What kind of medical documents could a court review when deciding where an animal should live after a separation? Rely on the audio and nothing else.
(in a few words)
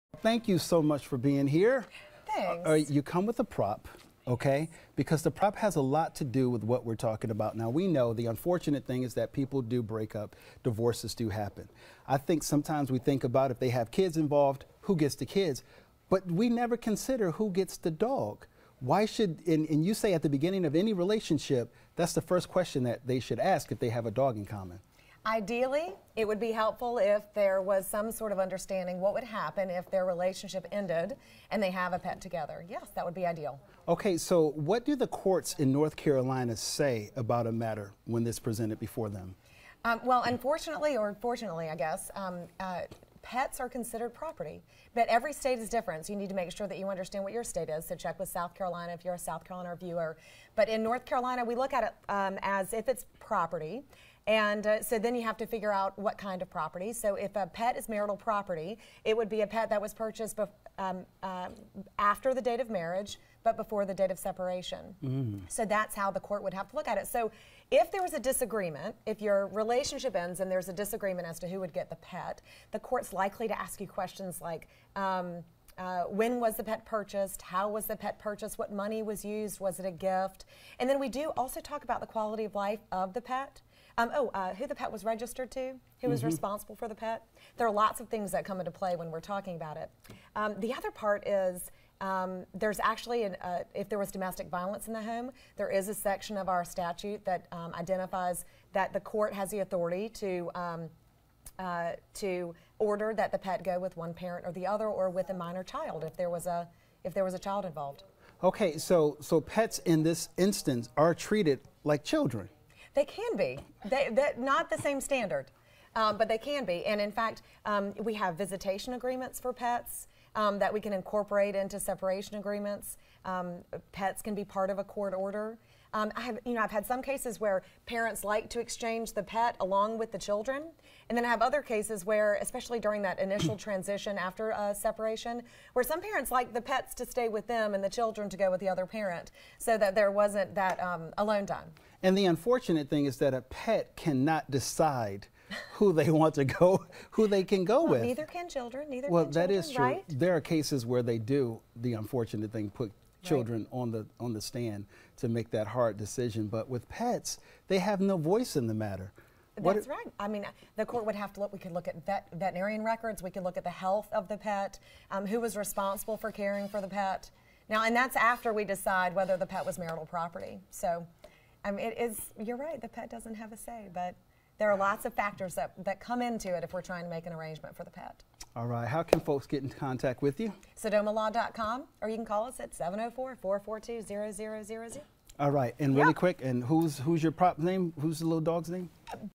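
Veterinarian records.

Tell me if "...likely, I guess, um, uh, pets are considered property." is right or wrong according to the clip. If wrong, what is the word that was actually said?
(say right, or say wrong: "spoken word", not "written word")
wrong: "fortunately", not "likely".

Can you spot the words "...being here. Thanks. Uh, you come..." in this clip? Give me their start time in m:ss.
0:01.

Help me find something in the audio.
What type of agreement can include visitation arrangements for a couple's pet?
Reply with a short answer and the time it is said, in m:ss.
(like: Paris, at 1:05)
Separation agreements, at 2:01.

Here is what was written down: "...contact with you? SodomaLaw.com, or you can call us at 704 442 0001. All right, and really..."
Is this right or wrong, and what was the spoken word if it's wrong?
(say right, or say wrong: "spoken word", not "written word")
wrong: "0000", not "0001".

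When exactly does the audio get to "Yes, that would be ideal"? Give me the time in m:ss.
0:32.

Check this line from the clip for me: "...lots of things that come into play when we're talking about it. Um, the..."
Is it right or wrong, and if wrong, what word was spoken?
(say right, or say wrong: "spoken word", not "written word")
right.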